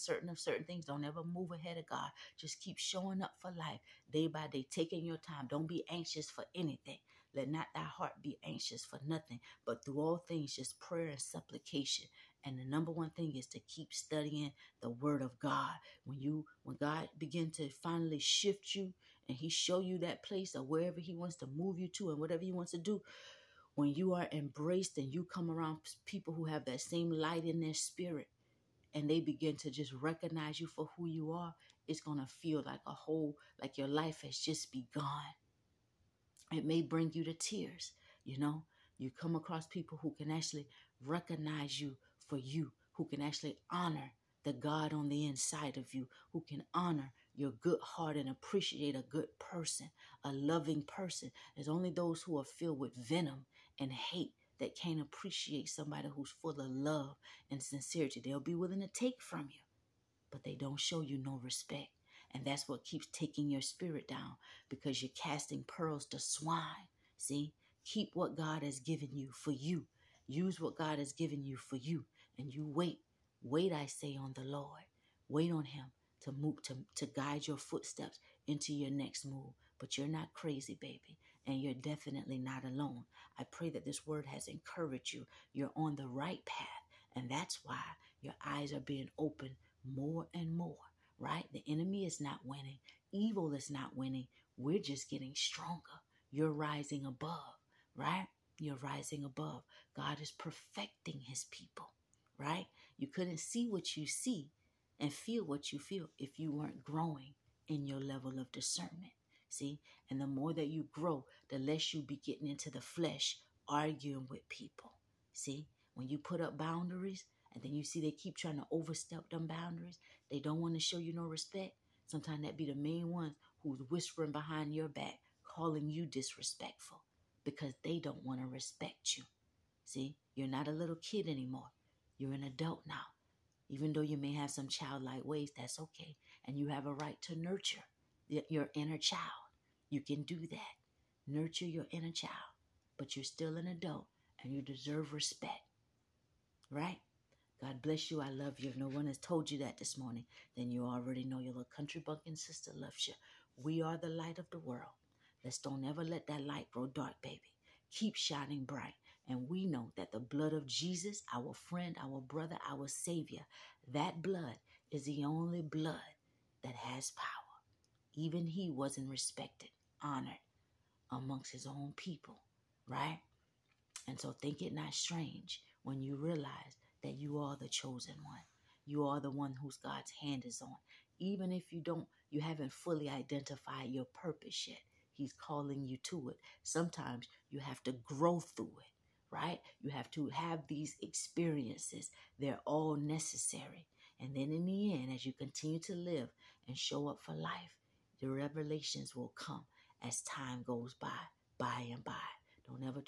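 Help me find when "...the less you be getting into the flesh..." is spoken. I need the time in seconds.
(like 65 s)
111 s.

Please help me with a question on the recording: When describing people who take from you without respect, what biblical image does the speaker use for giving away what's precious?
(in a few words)
Casting pearls to swine.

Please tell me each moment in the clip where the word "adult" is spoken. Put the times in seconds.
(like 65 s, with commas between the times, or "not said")
132 s, 143 s.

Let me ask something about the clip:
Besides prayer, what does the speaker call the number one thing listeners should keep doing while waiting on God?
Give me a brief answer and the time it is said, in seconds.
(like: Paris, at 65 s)
Studying the Word of God, at 13 s.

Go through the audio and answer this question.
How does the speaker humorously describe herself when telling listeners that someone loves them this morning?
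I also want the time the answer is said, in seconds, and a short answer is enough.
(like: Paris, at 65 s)
Little country bumpkin sister, at 151 s.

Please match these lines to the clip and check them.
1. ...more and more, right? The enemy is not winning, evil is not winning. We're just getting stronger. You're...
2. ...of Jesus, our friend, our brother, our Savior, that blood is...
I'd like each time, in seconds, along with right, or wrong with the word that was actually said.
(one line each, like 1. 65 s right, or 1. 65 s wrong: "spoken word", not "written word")
1. 89 s right
2. 160 s right.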